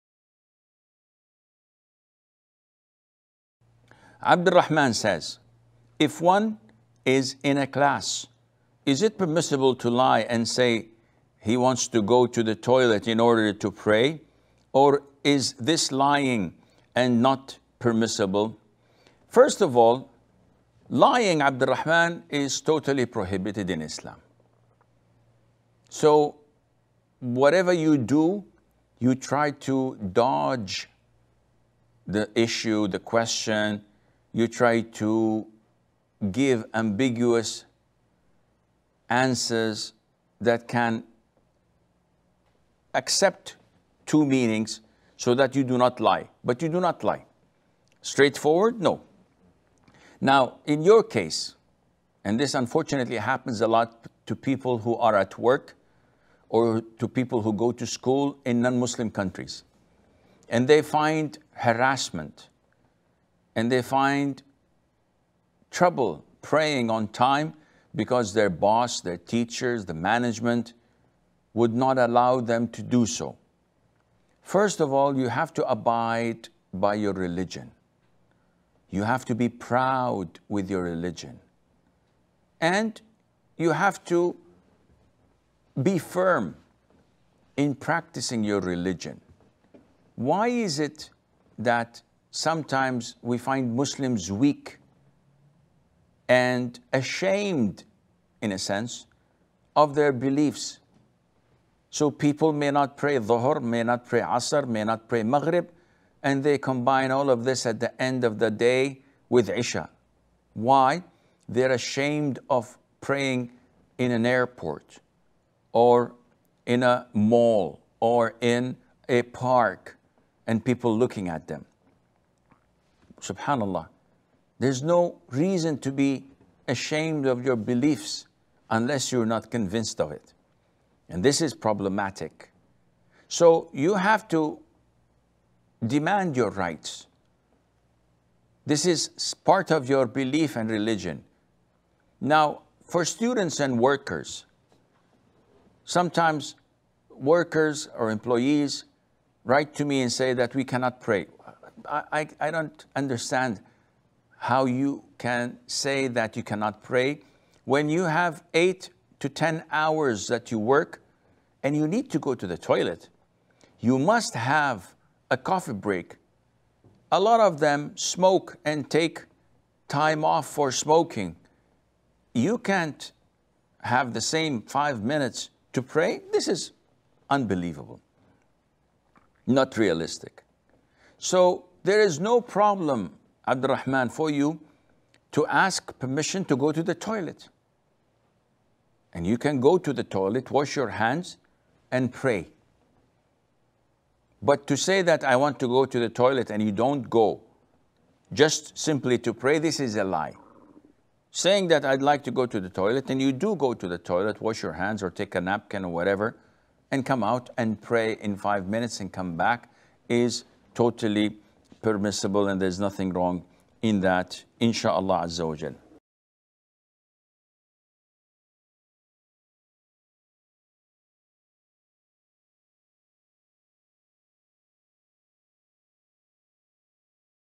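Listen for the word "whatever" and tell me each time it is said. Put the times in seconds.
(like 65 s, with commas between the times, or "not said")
27 s, 205 s.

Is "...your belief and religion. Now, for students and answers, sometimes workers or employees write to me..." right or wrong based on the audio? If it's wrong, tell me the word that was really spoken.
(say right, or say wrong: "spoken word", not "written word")
wrong: "workers", not "answers".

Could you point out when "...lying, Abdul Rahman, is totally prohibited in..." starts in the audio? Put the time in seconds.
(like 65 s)
20 s.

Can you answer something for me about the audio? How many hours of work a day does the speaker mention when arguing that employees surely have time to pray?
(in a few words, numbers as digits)
8 to 10.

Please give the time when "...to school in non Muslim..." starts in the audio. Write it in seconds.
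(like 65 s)
57 s.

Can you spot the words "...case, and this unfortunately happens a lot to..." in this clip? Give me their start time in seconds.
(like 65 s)
51 s.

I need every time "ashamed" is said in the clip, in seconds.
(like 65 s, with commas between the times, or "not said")
96 s, 111 s, 126 s.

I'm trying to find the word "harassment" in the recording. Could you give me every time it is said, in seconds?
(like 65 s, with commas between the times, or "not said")
61 s.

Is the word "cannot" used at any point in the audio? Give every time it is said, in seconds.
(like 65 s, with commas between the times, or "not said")
150 s, 156 s.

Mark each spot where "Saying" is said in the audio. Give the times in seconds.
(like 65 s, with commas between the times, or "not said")
201 s.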